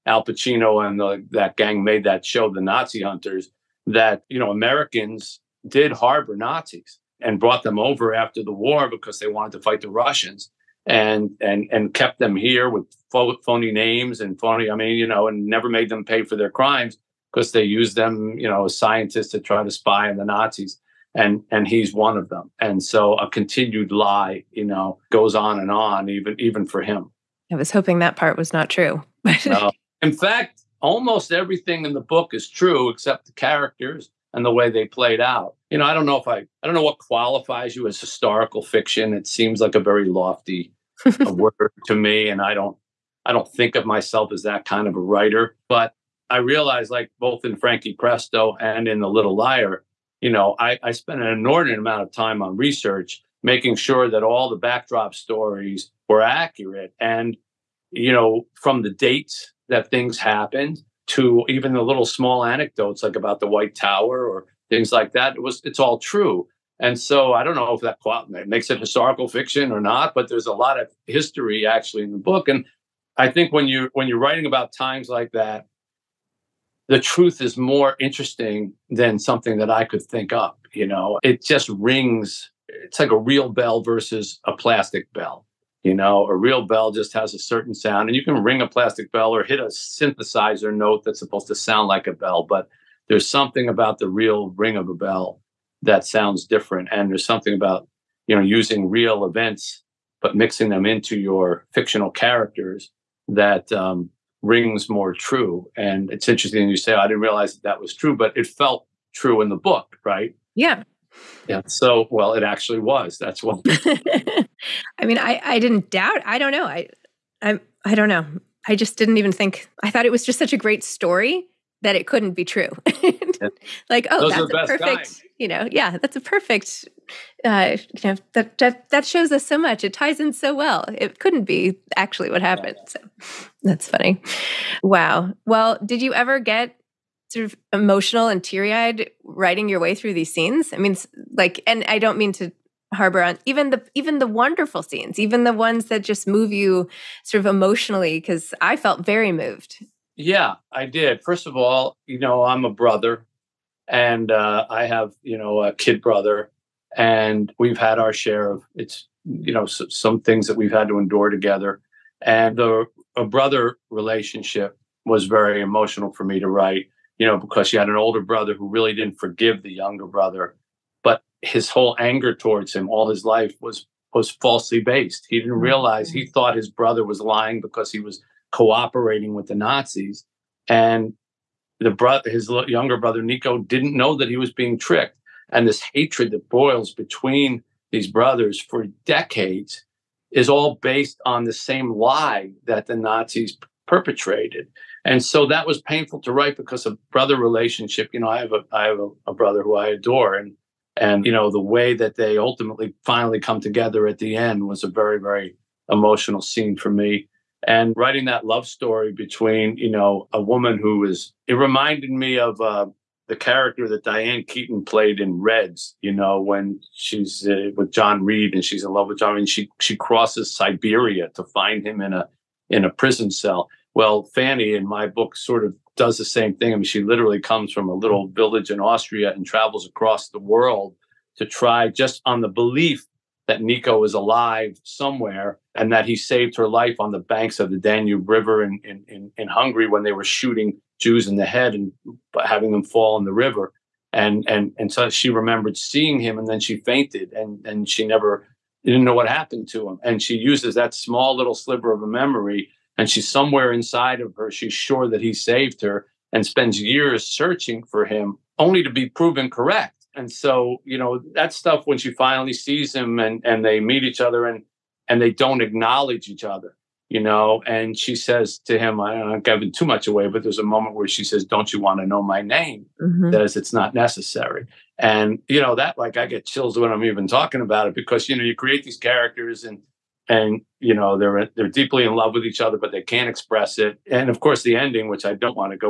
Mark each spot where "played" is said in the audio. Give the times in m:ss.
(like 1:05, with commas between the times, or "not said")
0:34, 3:34.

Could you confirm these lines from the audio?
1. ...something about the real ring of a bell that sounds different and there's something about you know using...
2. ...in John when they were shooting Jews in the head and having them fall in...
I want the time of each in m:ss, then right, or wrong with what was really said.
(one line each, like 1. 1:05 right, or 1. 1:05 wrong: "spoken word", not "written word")
1. 1:33 right
2. 3:59 wrong: "Hungary", not "John".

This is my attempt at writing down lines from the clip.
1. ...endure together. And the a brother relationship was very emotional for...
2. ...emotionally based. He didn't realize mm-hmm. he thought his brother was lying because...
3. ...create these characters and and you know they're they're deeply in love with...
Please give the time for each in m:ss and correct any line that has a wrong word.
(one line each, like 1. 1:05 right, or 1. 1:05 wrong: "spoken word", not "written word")
1. 2:40 right
2. 2:54 wrong: "falsely", not "emotionally"
3. 4:38 right.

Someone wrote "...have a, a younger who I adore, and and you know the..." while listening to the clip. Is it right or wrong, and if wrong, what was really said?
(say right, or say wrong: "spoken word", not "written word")
wrong: "brother", not "younger".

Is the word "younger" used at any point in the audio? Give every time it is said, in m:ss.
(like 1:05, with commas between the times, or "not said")
2:49, 3:02.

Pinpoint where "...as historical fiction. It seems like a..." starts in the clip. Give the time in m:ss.
0:37.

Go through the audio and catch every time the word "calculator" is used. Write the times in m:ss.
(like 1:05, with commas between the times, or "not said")
not said.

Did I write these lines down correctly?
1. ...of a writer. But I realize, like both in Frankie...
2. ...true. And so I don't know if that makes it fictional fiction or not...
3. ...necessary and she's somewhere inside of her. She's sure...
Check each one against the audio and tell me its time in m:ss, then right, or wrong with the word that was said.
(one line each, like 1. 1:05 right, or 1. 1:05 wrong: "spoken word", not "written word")
1. 0:44 right
2. 1:05 wrong: "historical", not "fictional"
3. 4:12 wrong: "memory", not "necessary".